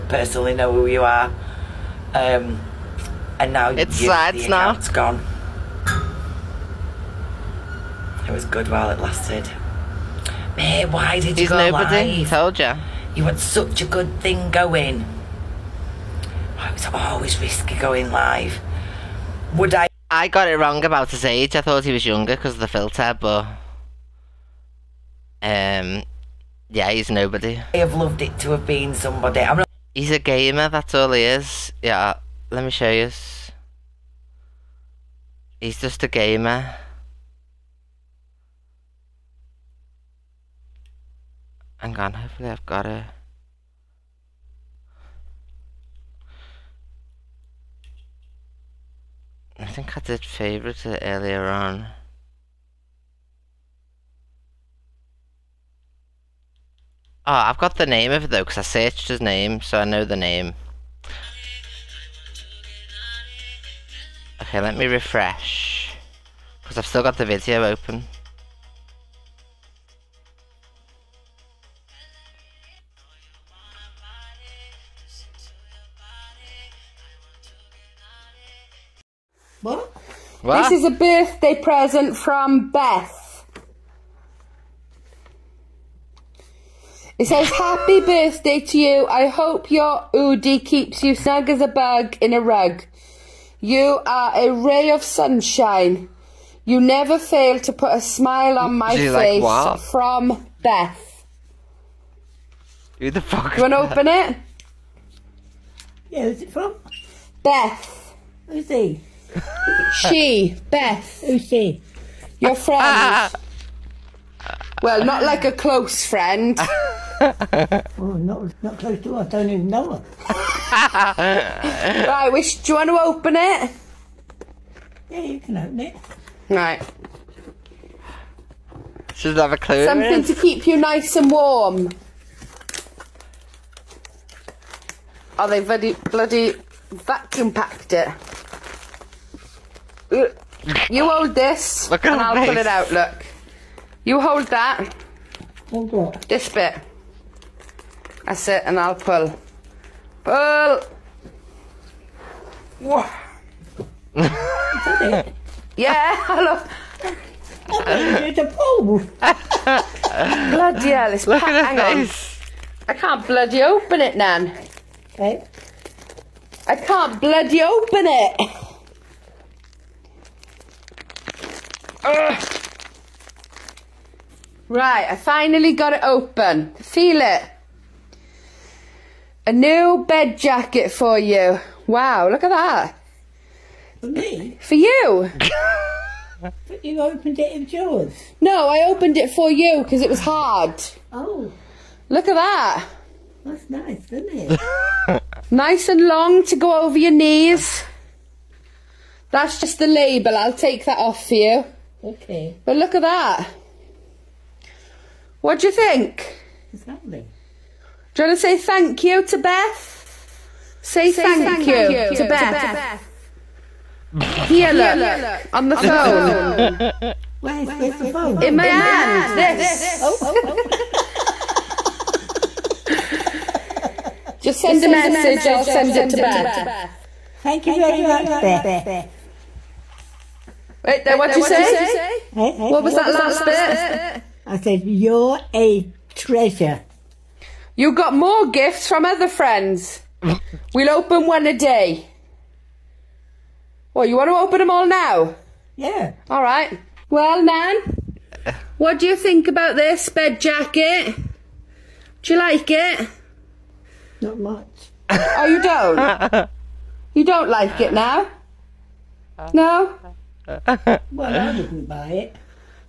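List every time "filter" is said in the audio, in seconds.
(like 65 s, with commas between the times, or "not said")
22 s.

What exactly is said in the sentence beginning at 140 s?
You hold this, Look and I'll face.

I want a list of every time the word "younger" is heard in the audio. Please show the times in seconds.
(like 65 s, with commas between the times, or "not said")
22 s.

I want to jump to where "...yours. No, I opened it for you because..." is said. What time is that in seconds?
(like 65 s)
187 s.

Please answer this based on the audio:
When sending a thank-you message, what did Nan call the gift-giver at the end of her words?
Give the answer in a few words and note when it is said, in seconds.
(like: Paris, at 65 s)
A treasure, at 235 s.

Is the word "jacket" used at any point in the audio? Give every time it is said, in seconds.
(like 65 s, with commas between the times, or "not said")
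180 s, 250 s.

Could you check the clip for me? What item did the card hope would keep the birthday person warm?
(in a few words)
Oodie.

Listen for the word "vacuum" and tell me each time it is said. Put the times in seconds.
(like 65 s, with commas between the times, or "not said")
136 s.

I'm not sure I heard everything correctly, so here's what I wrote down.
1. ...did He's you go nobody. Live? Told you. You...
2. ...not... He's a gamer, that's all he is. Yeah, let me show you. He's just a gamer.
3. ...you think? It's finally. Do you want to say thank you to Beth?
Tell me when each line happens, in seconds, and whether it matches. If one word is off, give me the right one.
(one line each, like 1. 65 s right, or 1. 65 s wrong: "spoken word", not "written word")
1. 11 s right
2. 29 s right
3. 205 s wrong: "lovely", not "finally".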